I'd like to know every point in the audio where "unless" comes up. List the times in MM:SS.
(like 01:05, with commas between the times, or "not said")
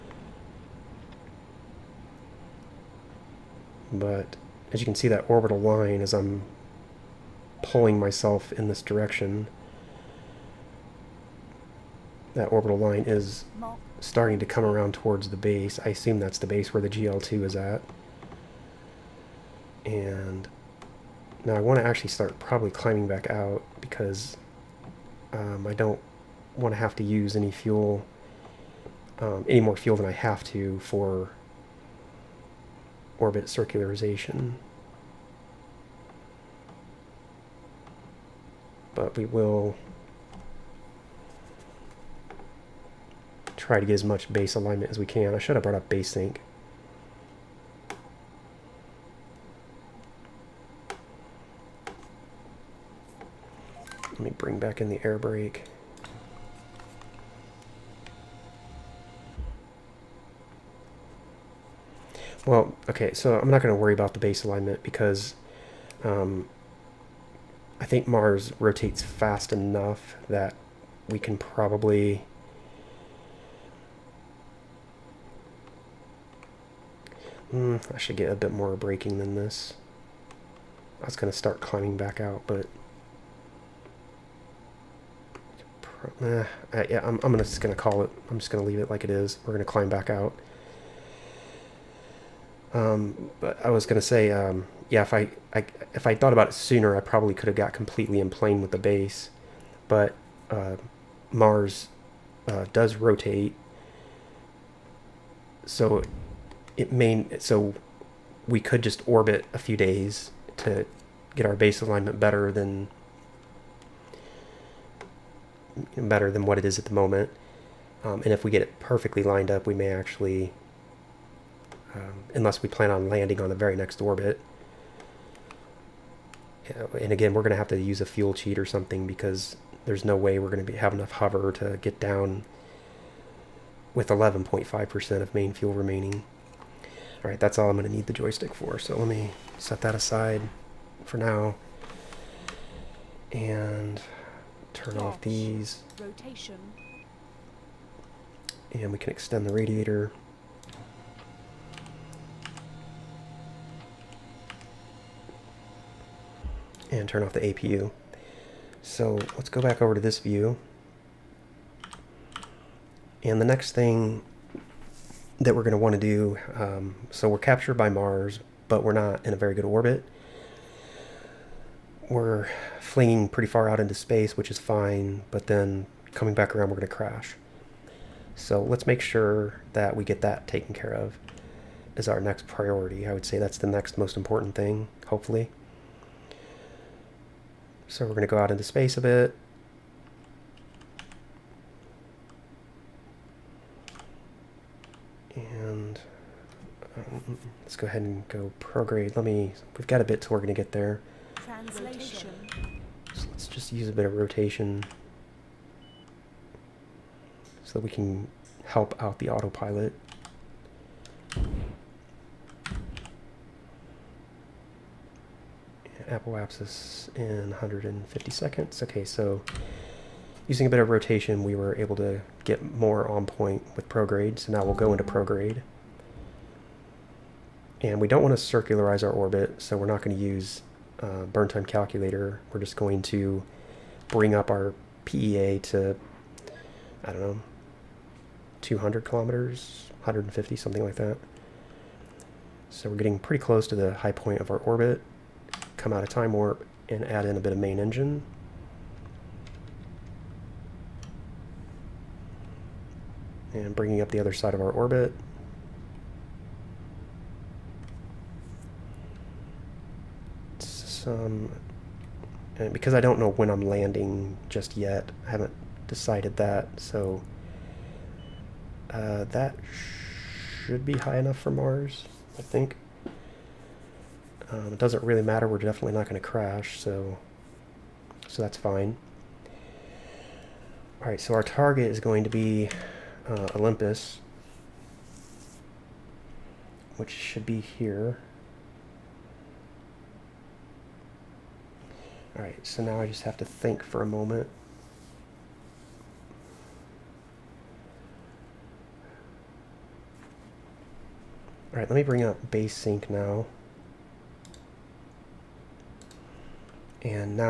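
02:02.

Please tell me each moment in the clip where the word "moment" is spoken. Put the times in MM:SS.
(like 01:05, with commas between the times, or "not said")
01:56, 04:54.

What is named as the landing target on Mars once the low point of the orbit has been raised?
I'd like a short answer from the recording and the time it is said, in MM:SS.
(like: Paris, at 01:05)
Olympus, at 04:43.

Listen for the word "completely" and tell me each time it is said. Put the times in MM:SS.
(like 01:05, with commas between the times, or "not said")
01:37.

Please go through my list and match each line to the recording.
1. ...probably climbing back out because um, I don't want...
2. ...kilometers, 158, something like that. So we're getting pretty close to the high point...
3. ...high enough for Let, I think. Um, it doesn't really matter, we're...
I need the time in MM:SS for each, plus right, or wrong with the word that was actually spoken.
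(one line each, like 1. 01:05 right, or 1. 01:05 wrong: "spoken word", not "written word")
1. 00:22 right
2. 03:59 wrong: "150", not "158"
3. 04:30 wrong: "Mars", not "Let".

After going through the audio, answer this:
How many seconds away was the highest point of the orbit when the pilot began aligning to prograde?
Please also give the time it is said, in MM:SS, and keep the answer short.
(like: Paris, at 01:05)
150, at 03:37.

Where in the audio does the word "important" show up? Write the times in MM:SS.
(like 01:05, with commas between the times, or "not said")
03:04.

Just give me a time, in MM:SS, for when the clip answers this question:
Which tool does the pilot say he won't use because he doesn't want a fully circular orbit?
03:51.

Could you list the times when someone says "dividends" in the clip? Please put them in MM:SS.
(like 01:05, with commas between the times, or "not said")
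not said.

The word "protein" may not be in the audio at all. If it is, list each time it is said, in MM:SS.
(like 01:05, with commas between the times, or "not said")
not said.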